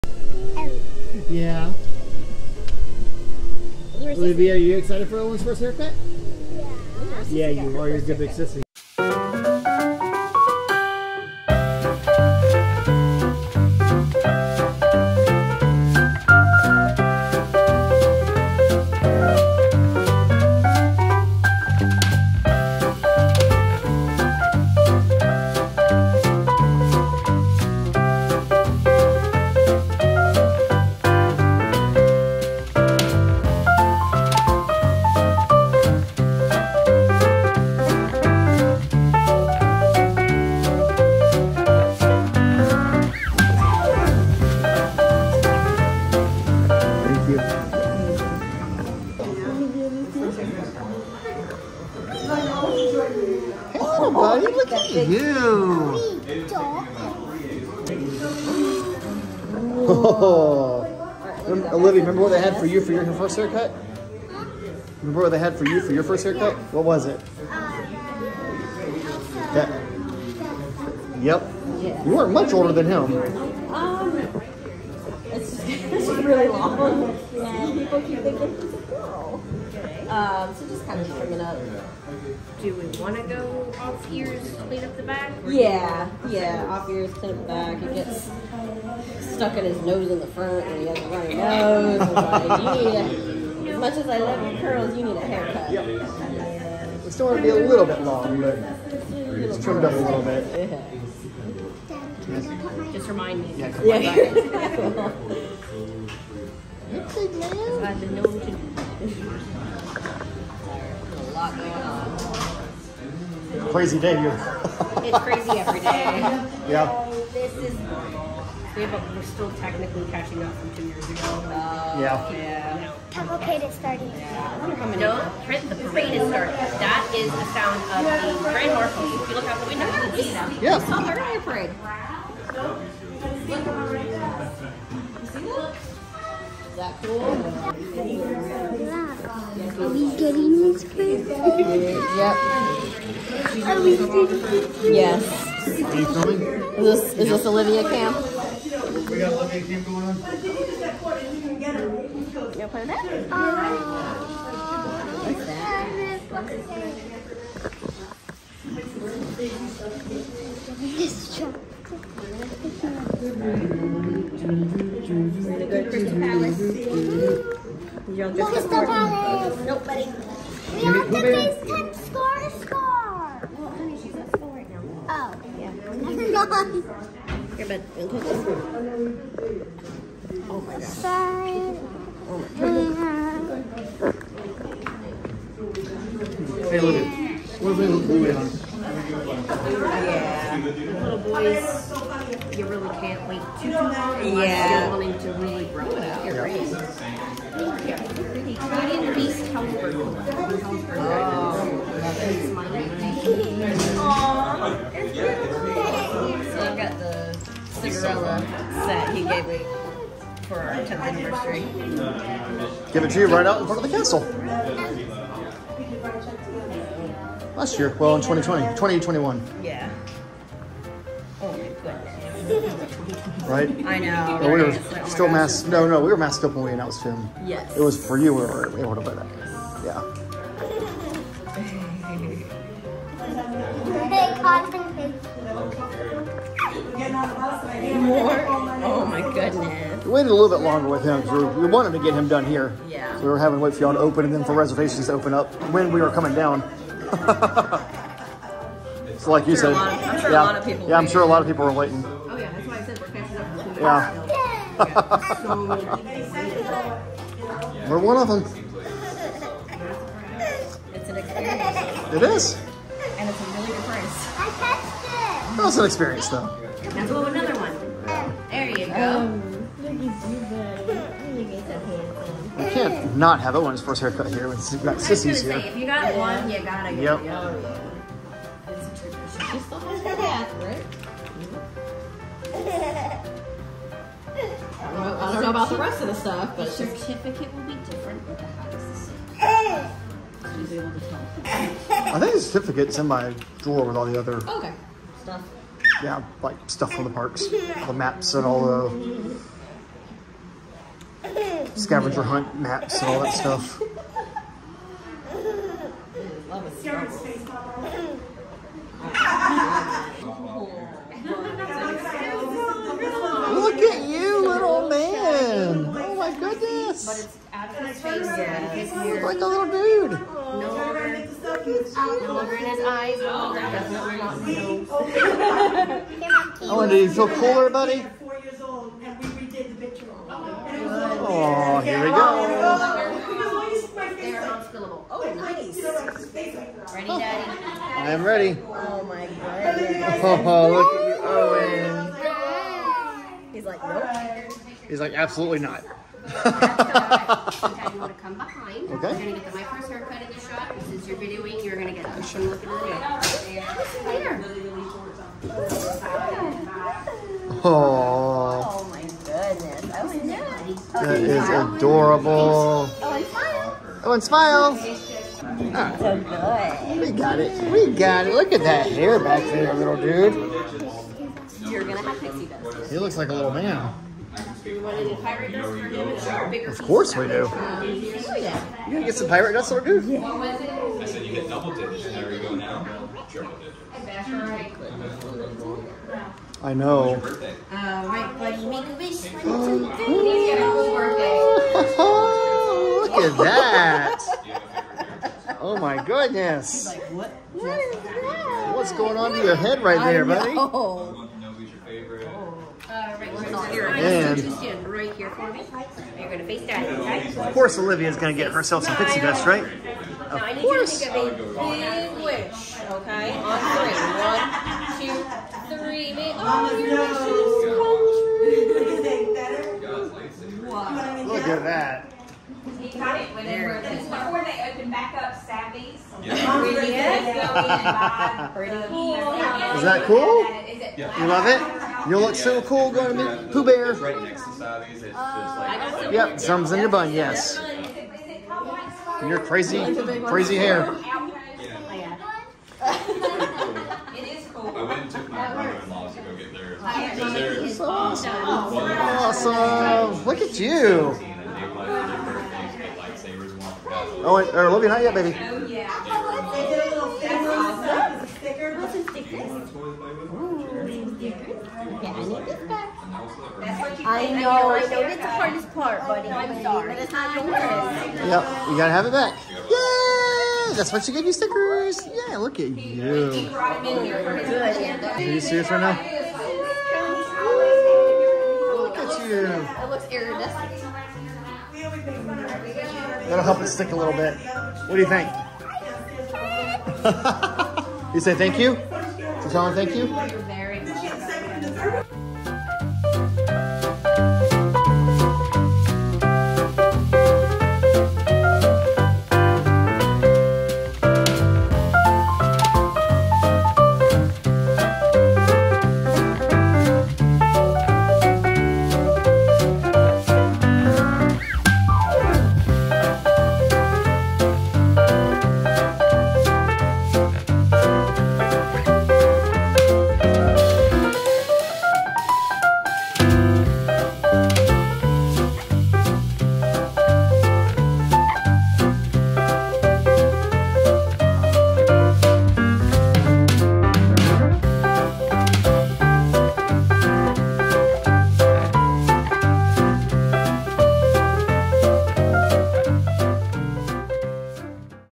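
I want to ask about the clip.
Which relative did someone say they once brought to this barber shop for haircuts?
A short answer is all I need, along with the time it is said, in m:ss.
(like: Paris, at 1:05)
Brother-in-law, at 7:25.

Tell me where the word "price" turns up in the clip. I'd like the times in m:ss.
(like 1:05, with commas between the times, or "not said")
4:23.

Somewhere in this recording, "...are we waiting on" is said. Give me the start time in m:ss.
3:07.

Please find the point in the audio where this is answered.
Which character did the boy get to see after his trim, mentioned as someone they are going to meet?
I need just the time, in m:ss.
7:13.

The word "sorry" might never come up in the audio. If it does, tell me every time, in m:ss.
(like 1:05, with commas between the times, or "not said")
3:00, 7:46.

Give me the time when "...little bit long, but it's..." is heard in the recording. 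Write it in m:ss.
1:37.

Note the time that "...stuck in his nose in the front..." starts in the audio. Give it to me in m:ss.
1:29.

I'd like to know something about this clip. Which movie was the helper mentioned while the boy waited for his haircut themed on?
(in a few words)
Beauty and the Beast.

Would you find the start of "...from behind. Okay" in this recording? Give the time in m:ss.
5:48.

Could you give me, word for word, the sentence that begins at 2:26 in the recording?
Is this, is this Olivia Camp?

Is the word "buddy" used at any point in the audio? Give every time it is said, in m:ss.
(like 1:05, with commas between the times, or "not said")
2:49, 4:32, 5:27, 6:40, 7:46.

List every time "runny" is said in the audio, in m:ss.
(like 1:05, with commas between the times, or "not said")
1:31.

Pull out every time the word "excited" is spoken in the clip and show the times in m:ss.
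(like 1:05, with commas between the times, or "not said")
0:04.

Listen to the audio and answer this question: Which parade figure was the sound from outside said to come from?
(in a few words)
Grand marshal.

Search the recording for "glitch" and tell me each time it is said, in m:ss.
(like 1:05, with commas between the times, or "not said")
not said.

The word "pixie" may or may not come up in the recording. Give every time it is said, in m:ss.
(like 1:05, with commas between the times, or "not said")
6:12, 6:48.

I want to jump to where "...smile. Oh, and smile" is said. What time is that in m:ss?
6:04.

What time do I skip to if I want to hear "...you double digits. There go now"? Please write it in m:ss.
6:21.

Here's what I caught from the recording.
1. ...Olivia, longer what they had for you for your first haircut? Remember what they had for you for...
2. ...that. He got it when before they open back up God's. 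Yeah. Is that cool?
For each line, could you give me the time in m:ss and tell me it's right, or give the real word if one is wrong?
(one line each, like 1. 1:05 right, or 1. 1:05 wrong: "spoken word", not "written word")
1. 1:01 wrong: "remember", not "longer"
2. 7:01 wrong: "Savvy", not "God".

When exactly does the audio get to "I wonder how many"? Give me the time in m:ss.
2:04.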